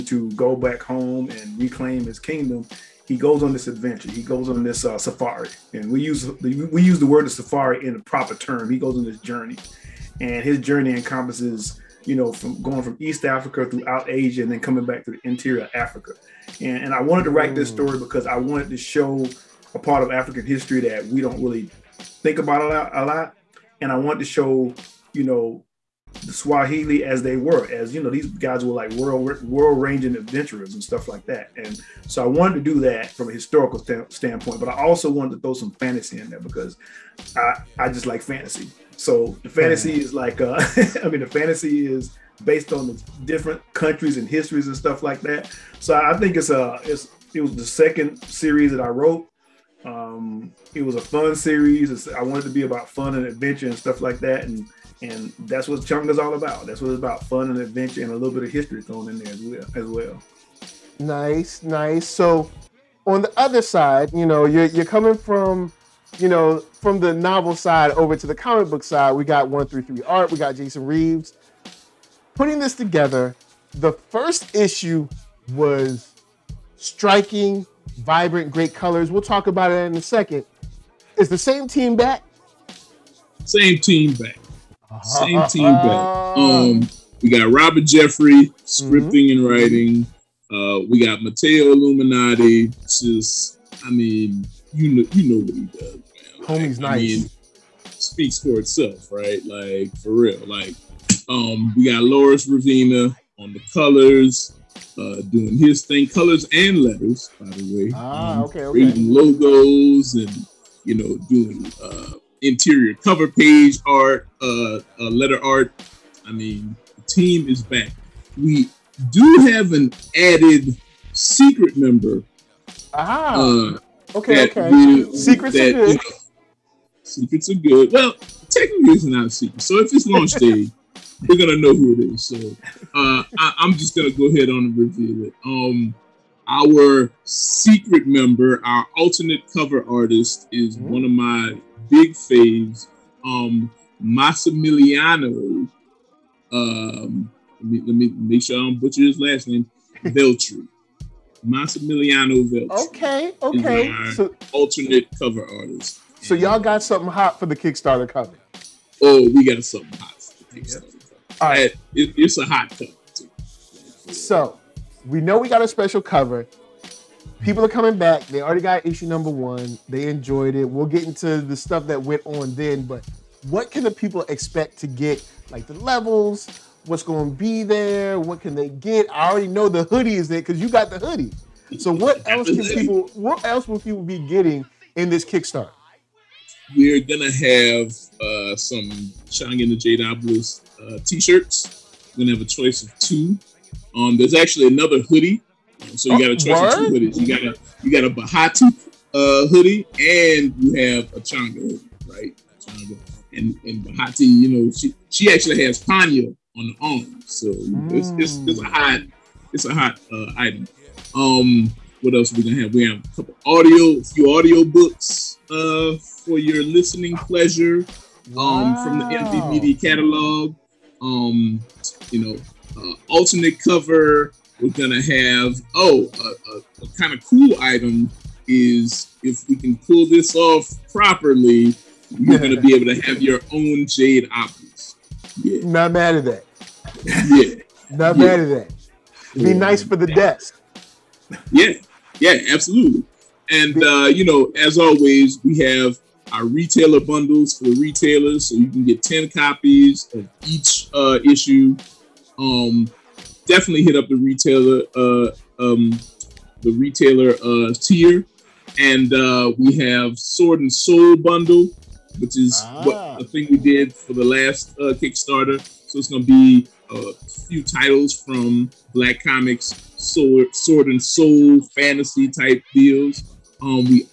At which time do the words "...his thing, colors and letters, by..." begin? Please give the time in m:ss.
1:45.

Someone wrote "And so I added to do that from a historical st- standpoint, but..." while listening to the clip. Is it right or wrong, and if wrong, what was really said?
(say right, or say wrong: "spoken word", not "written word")
wrong: "wanted", not "added".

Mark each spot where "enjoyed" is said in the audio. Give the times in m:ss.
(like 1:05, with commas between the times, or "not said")
2:50.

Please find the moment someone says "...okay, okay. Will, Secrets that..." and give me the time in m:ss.
2:04.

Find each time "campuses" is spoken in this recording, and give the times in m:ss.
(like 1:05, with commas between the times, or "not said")
not said.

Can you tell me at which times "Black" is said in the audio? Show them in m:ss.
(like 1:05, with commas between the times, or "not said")
4:28.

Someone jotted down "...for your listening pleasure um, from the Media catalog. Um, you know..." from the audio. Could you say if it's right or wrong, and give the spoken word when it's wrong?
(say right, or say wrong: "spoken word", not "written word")
right.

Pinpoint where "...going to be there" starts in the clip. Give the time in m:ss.
2:57.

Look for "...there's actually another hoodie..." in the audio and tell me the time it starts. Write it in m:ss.
3:14.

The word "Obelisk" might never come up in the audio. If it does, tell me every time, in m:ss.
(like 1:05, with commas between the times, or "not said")
3:09, 3:54.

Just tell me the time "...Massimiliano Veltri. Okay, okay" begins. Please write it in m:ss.
2:31.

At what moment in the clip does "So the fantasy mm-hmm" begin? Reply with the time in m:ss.
0:38.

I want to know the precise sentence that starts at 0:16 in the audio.
And, and I wanted to write this mm.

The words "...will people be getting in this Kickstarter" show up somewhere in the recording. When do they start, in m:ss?
3:03.